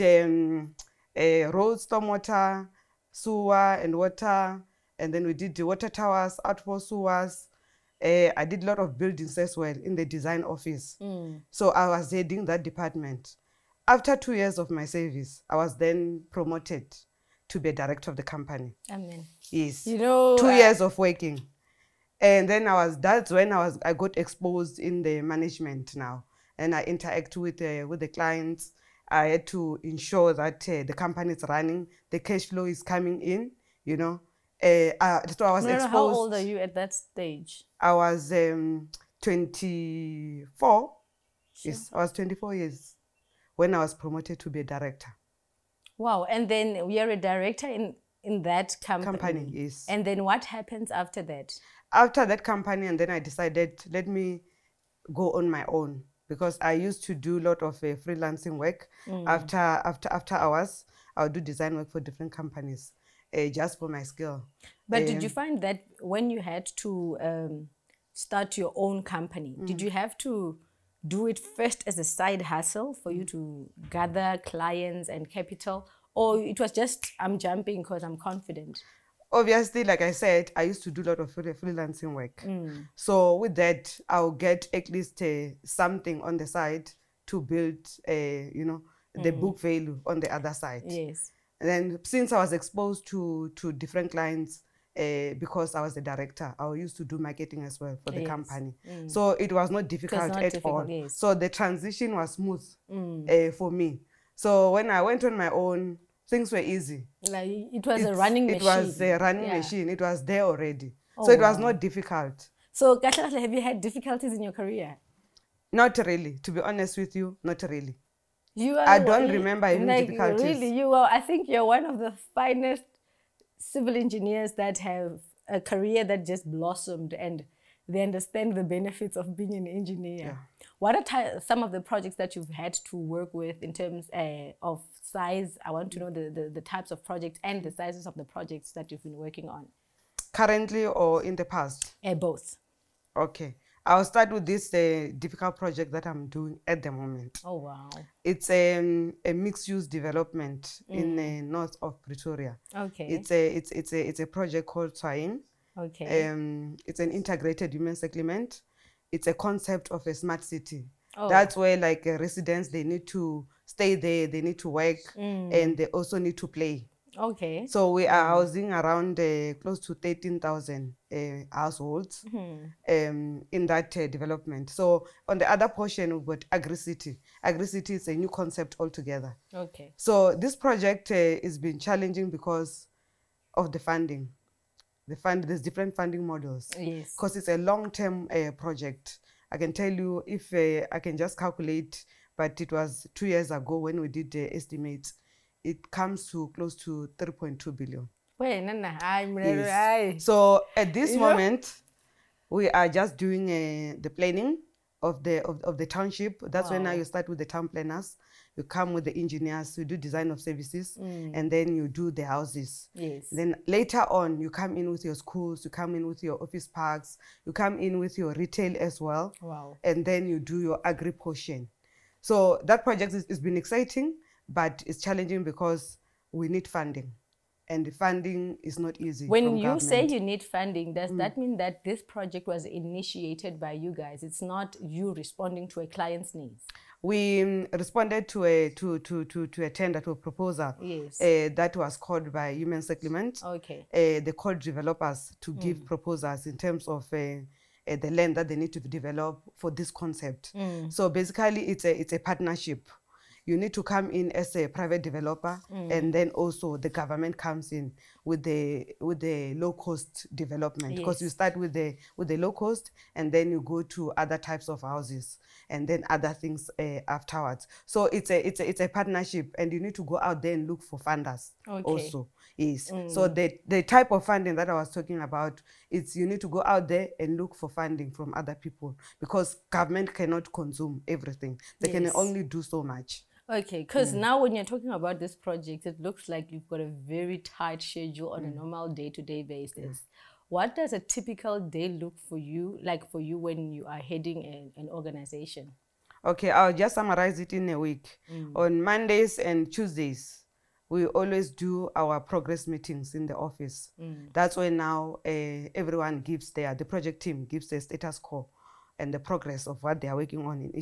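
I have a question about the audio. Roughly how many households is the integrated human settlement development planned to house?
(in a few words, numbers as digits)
13,000.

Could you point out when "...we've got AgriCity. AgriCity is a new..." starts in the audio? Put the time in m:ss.
2:56.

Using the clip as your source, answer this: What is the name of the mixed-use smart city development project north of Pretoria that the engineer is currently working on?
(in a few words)
Twain.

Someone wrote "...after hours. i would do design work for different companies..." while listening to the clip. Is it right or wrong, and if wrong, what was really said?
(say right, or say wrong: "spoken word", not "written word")
right.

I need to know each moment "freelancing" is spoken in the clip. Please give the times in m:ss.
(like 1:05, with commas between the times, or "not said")
0:58, 1:21.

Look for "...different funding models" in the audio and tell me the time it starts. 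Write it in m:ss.
3:05.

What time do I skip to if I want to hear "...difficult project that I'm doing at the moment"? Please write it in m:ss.
2:25.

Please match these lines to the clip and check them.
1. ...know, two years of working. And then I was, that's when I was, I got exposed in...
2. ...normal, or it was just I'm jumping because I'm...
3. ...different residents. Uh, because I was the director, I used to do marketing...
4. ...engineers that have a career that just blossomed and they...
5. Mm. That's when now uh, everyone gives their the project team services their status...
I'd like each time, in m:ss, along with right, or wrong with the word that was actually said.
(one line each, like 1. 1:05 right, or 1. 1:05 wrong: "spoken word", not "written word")
1. 0:19 right
2. 1:15 wrong: "capital", not "normal"
3. 1:33 wrong: "clients", not "residents"
4. 2:03 right
5. 5:03 wrong: "gives", not "services".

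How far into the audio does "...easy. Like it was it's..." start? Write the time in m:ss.
1:46.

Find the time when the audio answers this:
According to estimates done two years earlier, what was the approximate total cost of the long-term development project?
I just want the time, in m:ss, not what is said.
3:17.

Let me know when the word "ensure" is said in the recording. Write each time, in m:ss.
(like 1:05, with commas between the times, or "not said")
0:29.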